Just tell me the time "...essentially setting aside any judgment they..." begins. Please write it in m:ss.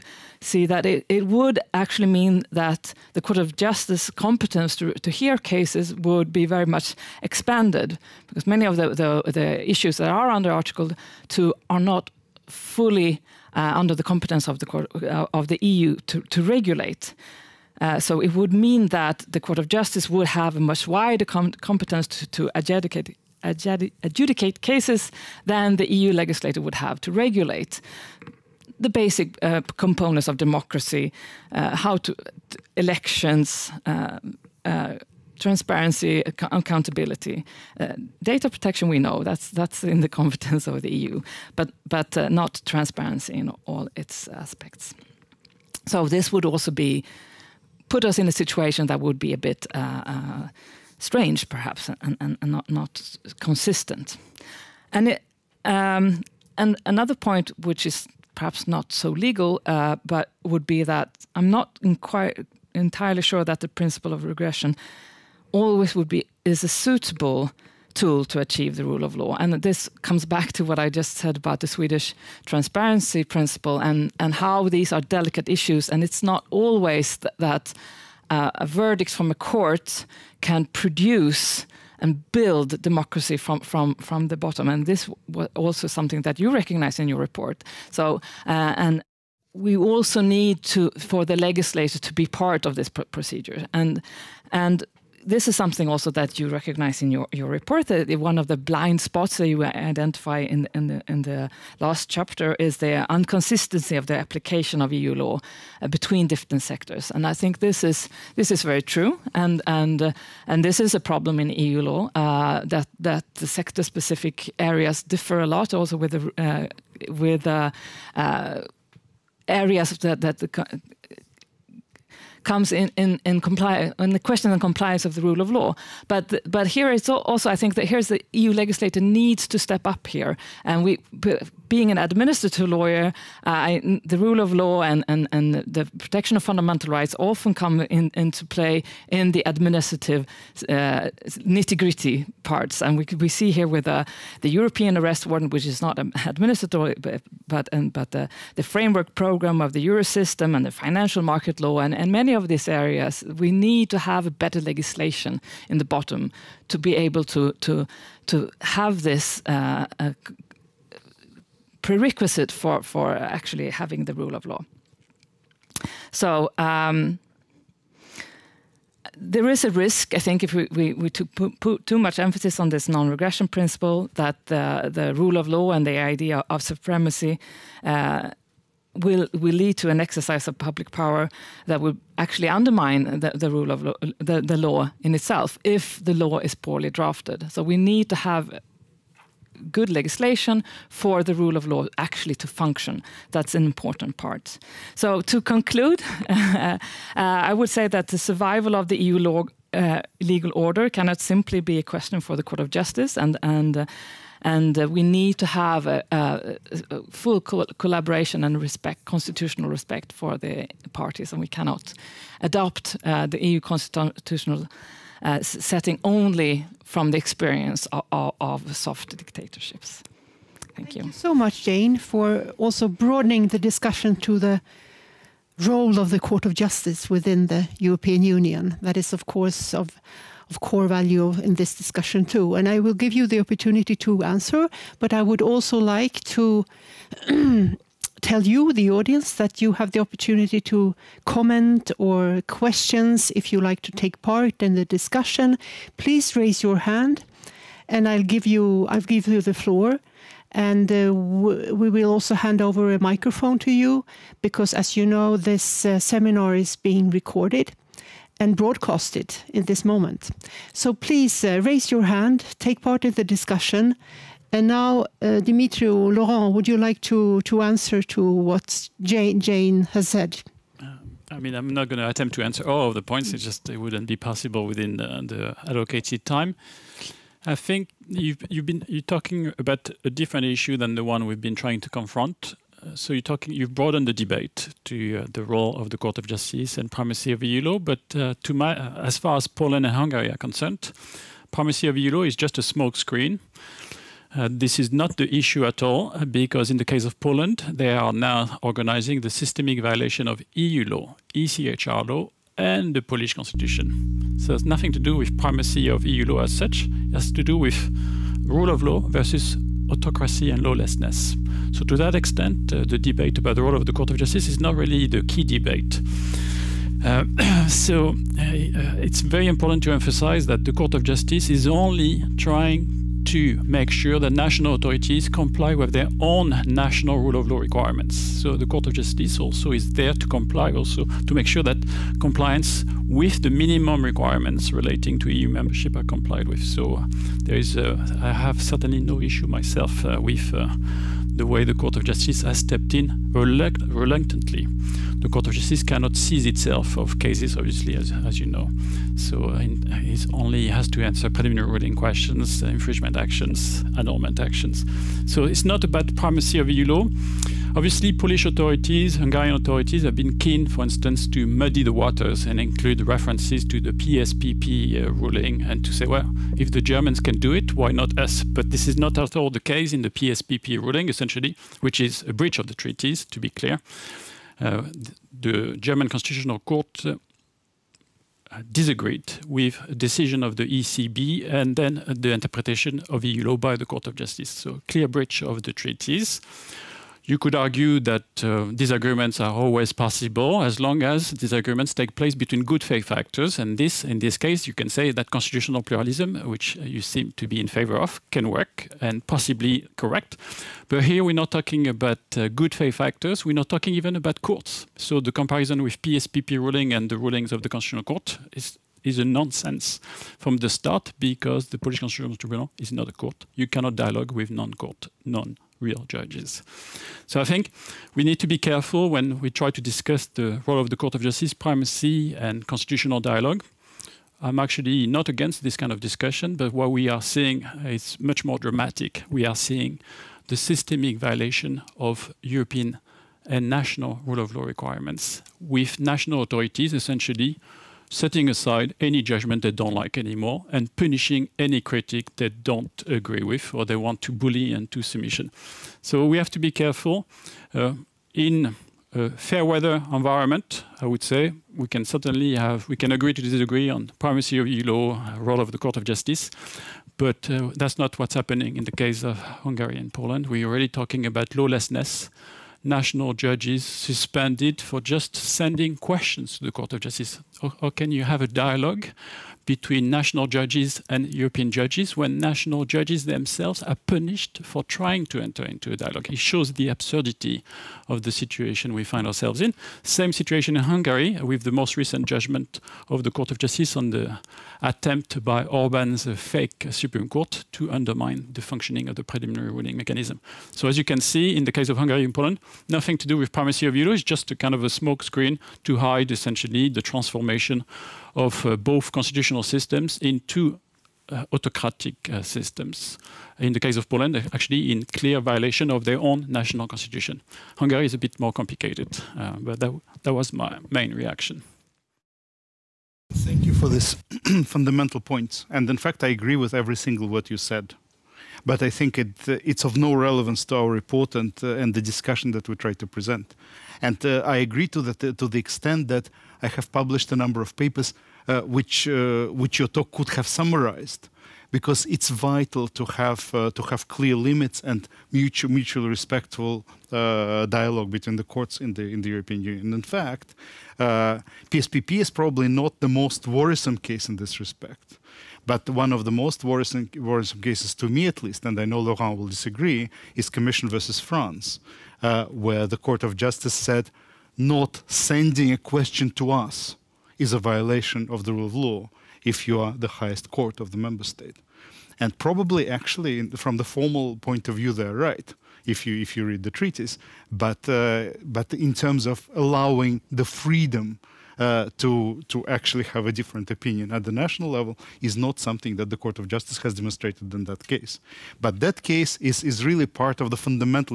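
7:16.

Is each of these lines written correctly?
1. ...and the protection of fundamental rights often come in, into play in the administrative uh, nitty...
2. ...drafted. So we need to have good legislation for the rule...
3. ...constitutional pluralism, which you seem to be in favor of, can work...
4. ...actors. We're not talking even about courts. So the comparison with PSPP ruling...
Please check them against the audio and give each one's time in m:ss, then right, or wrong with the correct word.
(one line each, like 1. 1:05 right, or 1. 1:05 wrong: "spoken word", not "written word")
1. 2:15 right
2. 3:06 right
3. 6:35 right
4. 6:43 right.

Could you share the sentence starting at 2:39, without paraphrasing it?
Uh, uh, prerequisite for, for actually having the rule of law.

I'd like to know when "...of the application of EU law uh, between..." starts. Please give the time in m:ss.
1:43.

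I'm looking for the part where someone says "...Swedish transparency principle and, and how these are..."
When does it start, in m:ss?
1:11.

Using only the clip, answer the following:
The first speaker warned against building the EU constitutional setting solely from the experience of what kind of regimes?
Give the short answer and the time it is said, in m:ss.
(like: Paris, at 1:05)
soft dictatorships, at 3:38.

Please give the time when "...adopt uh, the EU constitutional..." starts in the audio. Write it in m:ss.
3:32.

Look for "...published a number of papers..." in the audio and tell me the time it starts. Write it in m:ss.
8:46.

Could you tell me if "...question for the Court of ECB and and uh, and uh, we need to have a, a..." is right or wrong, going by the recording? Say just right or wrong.
wrong.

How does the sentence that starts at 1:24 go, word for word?
And this was also something that you recognize in your report.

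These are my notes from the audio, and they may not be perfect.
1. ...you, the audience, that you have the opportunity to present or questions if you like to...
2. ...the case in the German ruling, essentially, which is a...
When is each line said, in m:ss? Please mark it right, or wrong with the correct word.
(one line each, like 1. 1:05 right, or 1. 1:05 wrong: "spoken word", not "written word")
1. 3:58 wrong: "comment", not "present"
2. 6:09 wrong: "PSPP", not "German".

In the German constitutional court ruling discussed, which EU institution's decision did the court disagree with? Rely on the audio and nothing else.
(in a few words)
ECB.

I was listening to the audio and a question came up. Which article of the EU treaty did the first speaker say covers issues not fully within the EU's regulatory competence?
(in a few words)
Article 2.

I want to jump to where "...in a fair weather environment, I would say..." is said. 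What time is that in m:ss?
7:28.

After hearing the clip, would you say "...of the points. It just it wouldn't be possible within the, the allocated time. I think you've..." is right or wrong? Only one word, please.
right.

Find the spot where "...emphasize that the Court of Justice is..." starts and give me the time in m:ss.
5:19.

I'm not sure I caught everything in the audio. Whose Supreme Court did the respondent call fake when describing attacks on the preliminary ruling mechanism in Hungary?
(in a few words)
Orban.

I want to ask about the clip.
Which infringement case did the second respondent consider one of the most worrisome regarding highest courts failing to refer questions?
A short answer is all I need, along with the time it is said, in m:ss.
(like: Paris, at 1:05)
Commission versus France, at 9:10.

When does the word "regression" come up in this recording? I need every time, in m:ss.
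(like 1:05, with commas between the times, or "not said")
1:04, 2:52.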